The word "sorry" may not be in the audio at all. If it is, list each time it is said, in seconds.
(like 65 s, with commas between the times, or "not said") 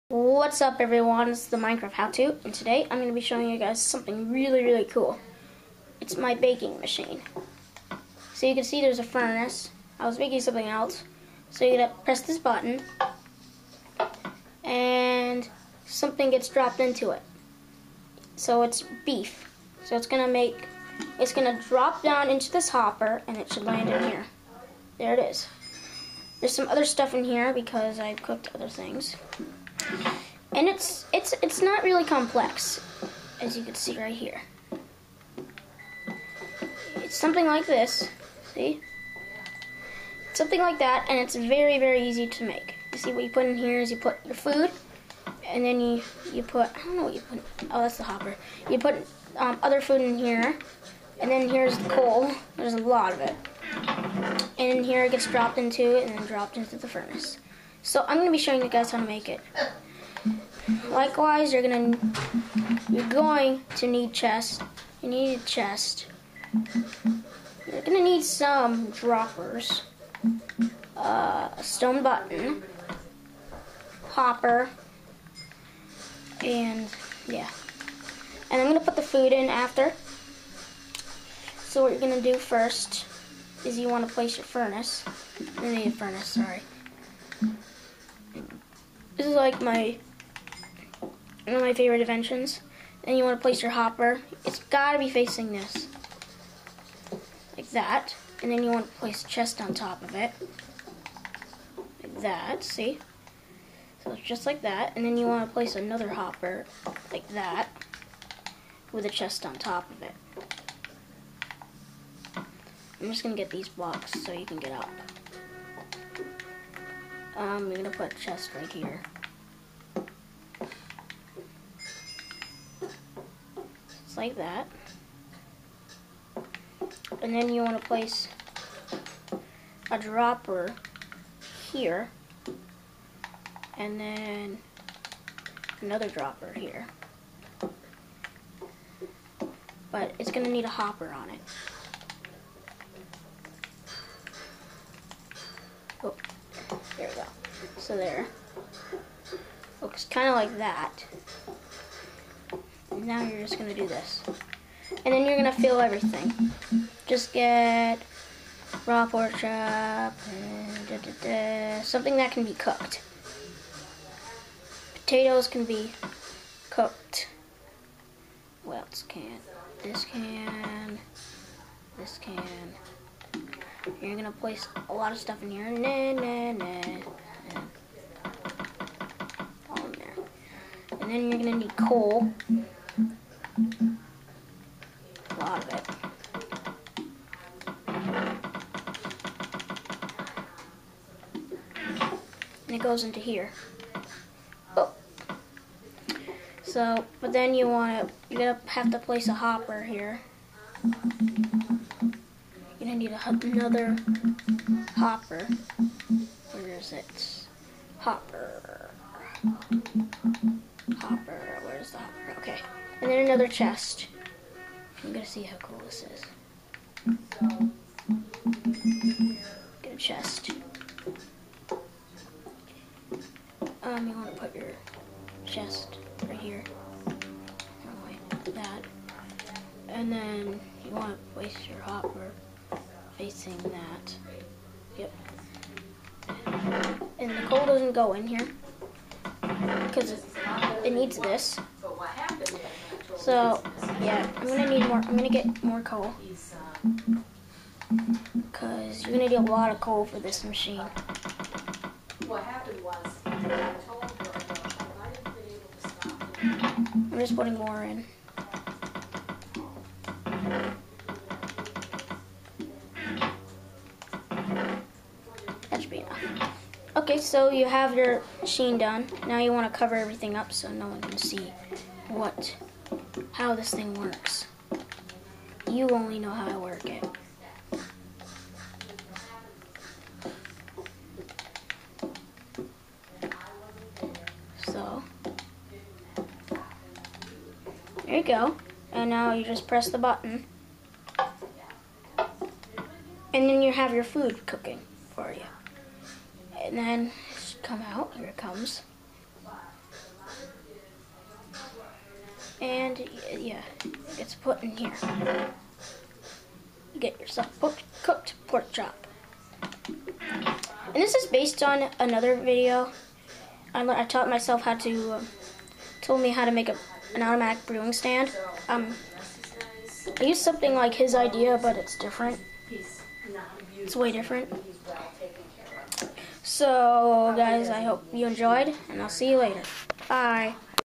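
86 s.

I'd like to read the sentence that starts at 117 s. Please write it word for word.
Um, I'm going to put a chest right here.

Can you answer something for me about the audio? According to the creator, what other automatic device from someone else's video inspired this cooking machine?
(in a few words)
automatic brewing stand.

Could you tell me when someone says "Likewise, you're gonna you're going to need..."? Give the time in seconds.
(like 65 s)
60 s.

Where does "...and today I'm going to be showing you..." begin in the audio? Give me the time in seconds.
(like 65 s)
2 s.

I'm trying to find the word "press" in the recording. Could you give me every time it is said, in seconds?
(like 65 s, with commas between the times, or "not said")
12 s, 289 s.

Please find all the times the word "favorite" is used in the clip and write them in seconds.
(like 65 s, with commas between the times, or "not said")
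91 s.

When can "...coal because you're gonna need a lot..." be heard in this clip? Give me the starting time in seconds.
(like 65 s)
245 s.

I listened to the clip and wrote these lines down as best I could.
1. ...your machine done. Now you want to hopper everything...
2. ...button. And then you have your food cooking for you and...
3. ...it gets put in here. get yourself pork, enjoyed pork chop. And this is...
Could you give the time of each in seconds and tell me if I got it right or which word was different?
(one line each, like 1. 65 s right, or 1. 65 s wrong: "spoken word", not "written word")
1. 267 s wrong: "cover", not "hopper"
2. 289 s right
3. 303 s wrong: "cooked", not "enjoyed".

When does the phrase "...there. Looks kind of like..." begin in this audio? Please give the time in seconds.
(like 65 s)
147 s.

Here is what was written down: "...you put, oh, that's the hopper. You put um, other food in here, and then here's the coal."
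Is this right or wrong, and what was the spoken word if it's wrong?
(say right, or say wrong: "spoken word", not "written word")
right.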